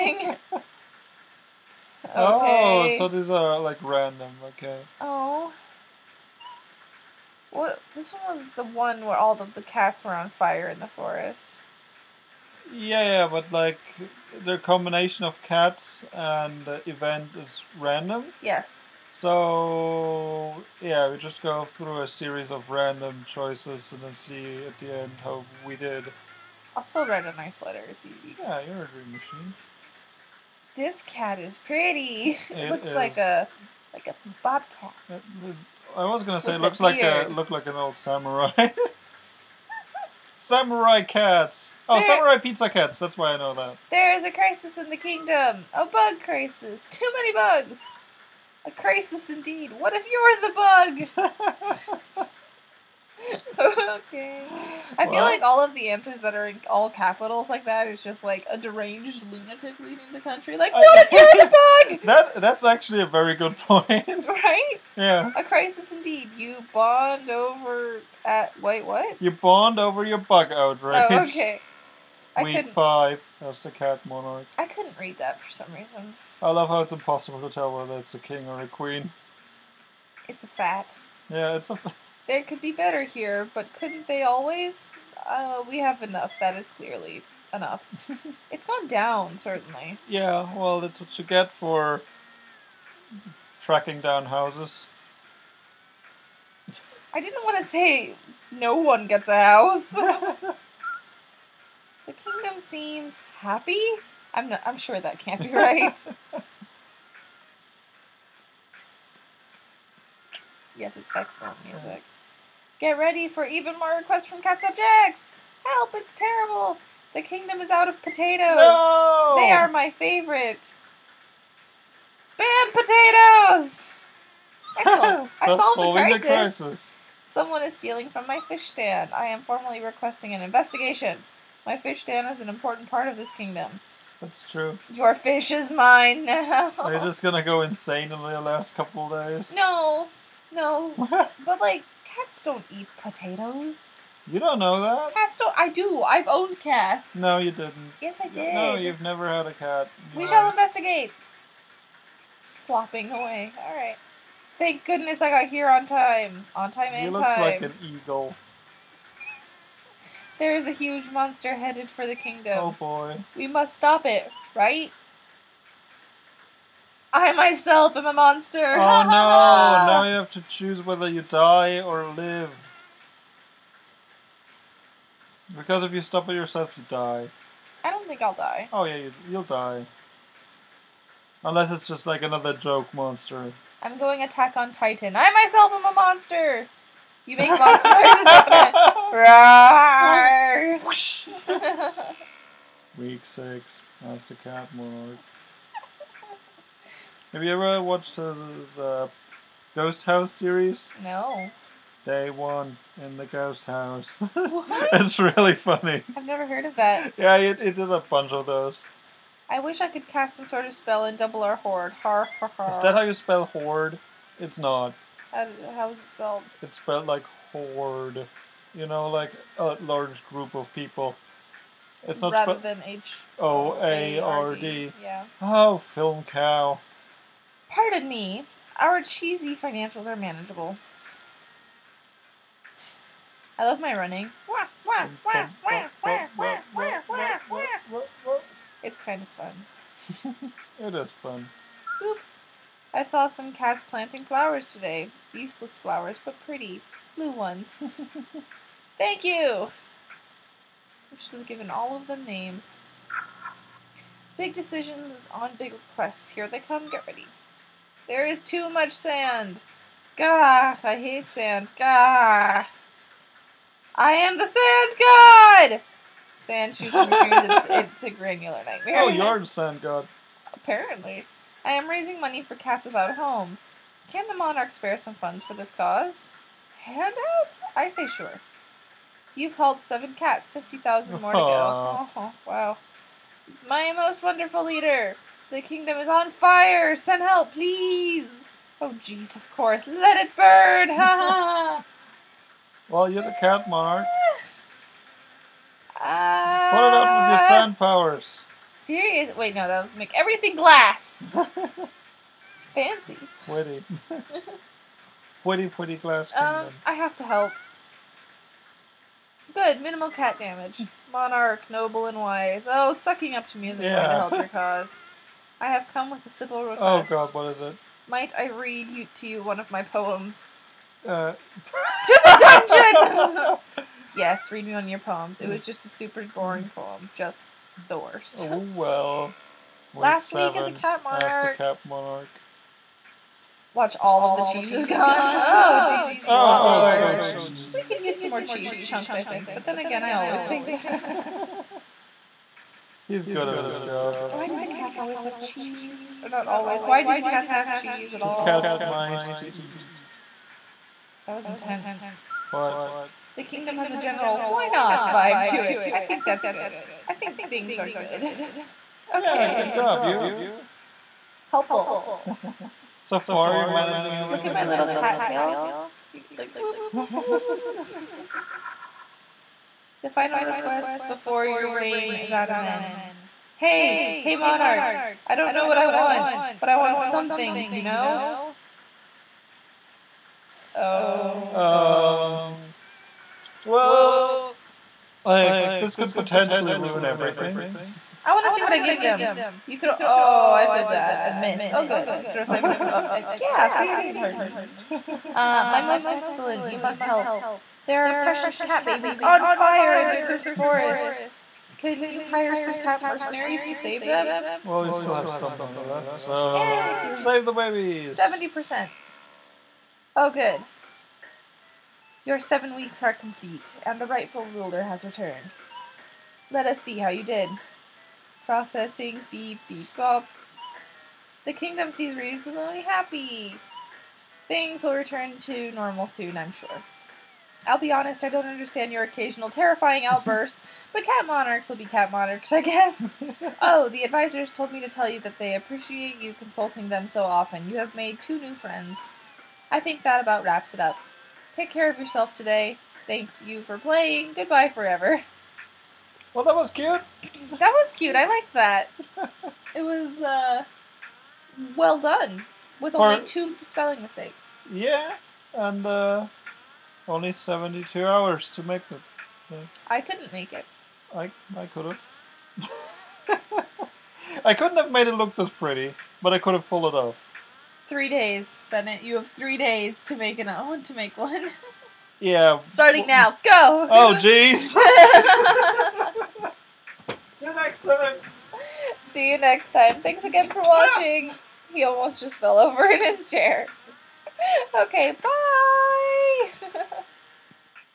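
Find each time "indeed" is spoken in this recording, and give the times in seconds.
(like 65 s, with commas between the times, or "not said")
49 s, 65 s.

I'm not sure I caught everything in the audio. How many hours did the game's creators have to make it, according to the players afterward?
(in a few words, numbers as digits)
72.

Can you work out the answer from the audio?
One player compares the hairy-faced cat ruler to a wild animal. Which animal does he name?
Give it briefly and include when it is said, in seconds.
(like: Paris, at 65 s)
bobcat, at 33 s.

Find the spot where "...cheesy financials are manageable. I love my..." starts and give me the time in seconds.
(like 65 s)
228 s.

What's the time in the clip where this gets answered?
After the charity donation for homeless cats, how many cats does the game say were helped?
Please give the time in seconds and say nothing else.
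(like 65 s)
279 s.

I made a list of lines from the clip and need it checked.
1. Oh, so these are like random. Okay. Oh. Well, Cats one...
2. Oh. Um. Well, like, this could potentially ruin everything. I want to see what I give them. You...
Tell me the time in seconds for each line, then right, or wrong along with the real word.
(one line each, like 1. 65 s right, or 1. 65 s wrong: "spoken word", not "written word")
1. 2 s wrong: "This", not "Cats"
2. 380 s right.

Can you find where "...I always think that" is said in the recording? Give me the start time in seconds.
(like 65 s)
340 s.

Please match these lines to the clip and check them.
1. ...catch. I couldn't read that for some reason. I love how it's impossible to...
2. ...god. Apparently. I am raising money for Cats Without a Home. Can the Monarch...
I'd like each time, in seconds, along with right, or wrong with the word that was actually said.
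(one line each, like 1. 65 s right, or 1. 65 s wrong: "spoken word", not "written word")
1. 74 s wrong: "monarch", not "catch"
2. 269 s right.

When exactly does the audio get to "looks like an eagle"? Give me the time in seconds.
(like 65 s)
157 s.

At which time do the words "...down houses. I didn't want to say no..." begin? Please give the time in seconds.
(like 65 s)
93 s.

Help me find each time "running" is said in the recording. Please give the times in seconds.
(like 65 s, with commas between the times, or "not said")
233 s.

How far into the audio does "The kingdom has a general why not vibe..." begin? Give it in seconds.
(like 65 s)
353 s.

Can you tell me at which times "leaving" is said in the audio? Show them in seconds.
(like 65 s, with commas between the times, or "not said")
59 s.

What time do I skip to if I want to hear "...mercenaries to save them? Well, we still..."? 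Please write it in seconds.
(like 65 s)
403 s.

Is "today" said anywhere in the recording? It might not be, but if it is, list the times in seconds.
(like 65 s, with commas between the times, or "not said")
244 s, 442 s.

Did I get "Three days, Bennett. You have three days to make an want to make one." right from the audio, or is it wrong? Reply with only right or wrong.
right.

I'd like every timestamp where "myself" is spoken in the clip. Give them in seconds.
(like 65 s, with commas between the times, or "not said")
167 s, 185 s.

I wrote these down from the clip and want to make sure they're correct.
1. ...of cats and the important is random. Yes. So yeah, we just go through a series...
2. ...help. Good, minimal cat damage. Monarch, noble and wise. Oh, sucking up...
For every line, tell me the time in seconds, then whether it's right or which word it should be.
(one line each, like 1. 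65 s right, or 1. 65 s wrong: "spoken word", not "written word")
1. 15 s wrong: "event", not "important"
2. 307 s right.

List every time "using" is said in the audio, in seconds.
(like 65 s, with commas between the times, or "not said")
not said.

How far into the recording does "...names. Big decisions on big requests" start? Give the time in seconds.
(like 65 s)
252 s.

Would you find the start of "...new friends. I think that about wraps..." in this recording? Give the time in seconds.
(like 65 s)
438 s.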